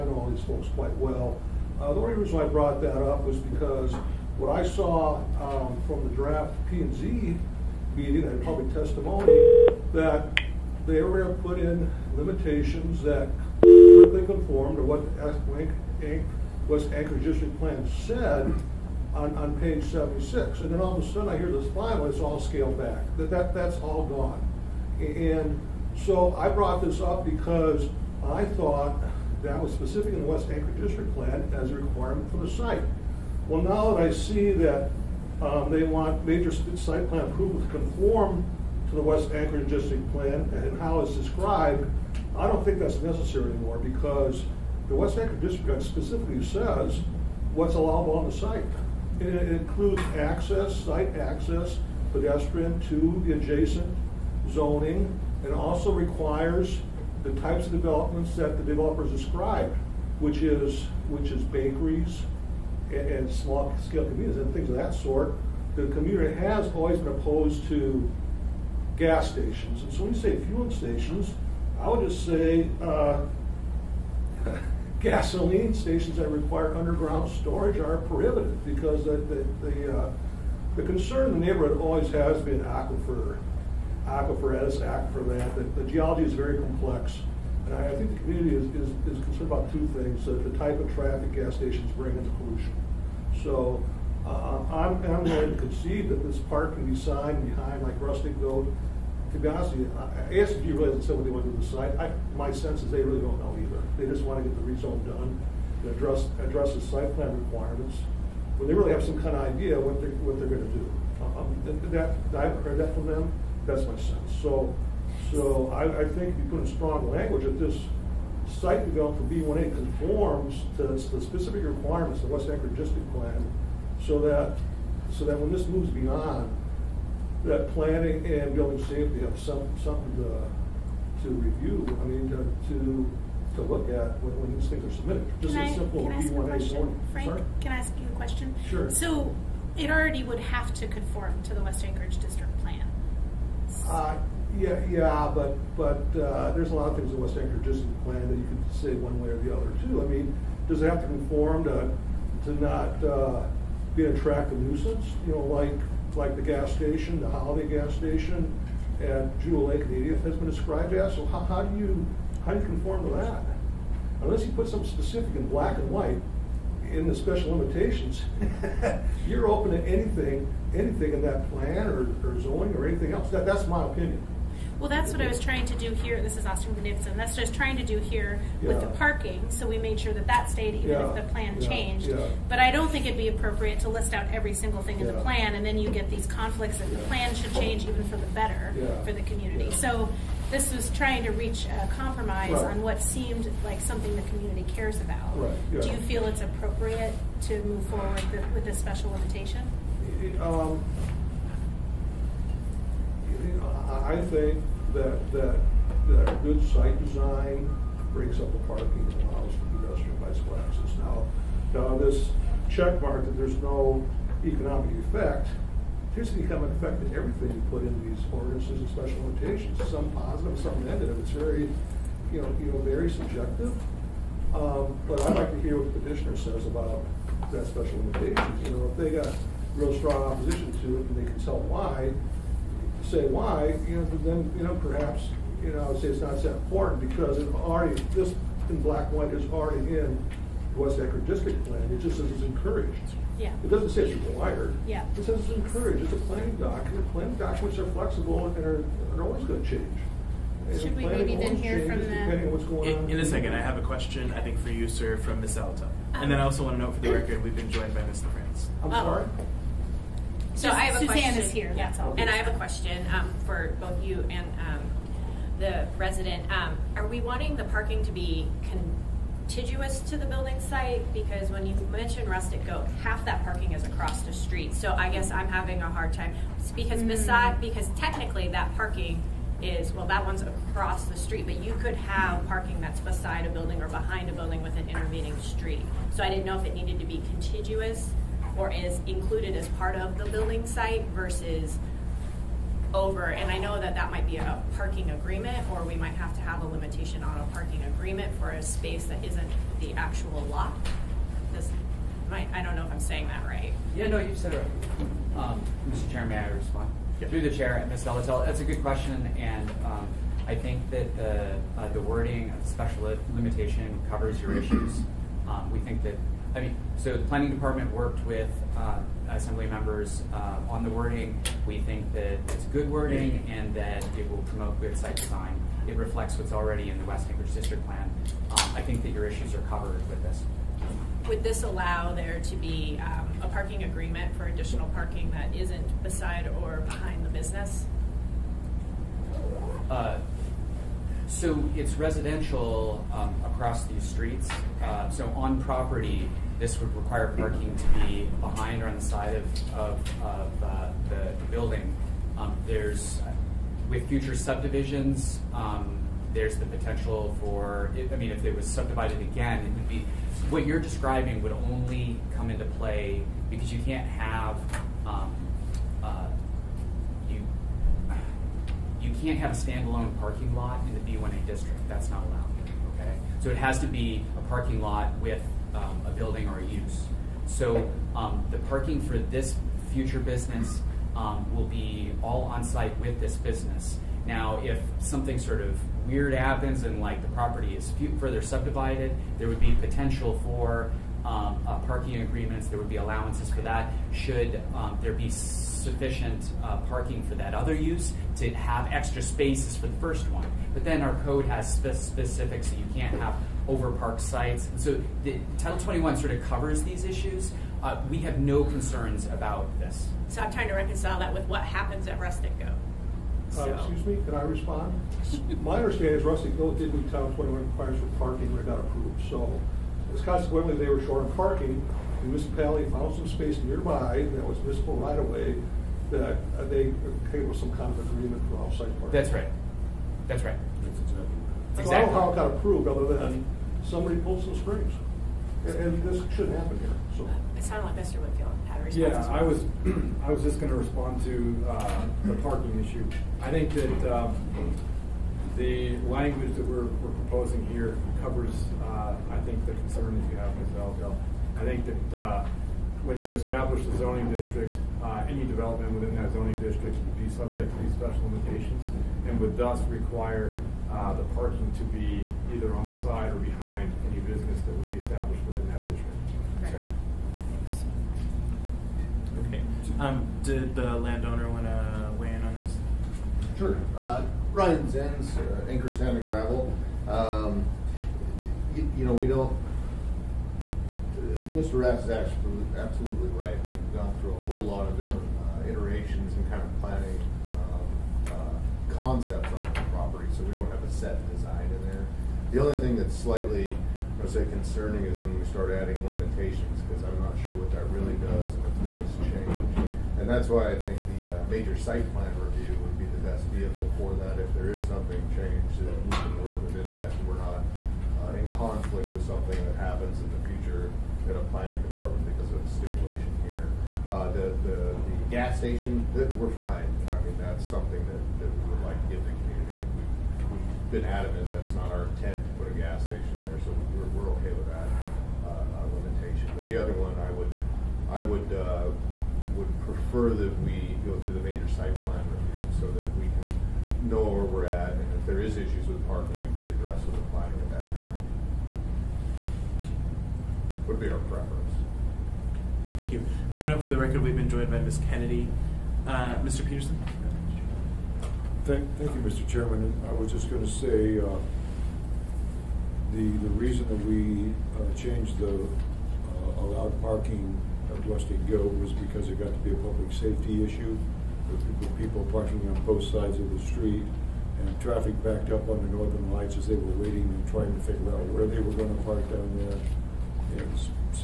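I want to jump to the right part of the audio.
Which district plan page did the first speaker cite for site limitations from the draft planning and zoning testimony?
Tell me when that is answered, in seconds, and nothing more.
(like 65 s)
19 s.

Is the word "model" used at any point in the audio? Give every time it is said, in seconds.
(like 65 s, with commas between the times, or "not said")
not said.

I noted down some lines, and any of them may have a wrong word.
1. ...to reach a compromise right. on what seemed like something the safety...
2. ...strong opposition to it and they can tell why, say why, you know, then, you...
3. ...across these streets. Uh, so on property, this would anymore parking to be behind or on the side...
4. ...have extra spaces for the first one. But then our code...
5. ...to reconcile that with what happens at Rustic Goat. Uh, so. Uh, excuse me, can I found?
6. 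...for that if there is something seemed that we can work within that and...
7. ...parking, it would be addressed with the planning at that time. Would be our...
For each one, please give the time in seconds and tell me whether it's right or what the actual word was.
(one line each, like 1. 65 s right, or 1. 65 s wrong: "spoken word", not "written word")
1. 191 s wrong: "community", not "safety"
2. 229 s right
3. 343 s wrong: "require", not "anymore"
4. 398 s right
5. 410 s wrong: "respond", not "found"
6. 503 s wrong: "changed", not "seemed"
7. 536 s right.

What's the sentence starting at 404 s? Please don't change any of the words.
So the, Title 21 sort of covers these issues.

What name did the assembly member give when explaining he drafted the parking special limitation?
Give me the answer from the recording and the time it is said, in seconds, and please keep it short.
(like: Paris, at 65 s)
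Austin Knudsen, at 176 s.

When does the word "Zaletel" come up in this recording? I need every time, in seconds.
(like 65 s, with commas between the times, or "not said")
308 s.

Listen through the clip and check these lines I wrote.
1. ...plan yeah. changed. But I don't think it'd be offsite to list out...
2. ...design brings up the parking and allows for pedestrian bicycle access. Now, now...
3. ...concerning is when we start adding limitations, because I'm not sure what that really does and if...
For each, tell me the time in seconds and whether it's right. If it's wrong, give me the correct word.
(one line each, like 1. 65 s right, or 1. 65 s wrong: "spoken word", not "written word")
1. 181 s wrong: "appropriate", not "offsite"
2. 207 s right
3. 494 s right.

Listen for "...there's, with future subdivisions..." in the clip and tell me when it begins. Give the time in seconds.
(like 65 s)
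352 s.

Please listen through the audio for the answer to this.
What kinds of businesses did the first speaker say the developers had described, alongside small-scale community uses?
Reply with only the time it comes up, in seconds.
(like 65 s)
61 s.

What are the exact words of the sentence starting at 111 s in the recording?
Uh, um, that, I've heard that from them.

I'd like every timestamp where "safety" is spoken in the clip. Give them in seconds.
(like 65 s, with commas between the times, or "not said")
128 s, 560 s.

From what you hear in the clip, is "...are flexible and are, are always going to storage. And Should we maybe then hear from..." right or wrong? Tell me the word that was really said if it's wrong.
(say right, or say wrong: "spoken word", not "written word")
wrong: "change", not "storage".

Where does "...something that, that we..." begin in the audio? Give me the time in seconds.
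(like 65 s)
517 s.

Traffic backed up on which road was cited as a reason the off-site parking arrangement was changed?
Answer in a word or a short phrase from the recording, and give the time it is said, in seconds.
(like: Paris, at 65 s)
Northern Lights, at 565 s.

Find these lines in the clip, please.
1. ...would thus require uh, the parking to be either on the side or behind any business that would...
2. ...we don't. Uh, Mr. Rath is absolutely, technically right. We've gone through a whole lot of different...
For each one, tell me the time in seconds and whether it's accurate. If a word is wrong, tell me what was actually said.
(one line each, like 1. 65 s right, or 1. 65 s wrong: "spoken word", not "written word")
1. 459 s right
2. 479 s wrong: "absolutely", not "technically".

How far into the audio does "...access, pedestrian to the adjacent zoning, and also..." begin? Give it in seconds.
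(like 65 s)
51 s.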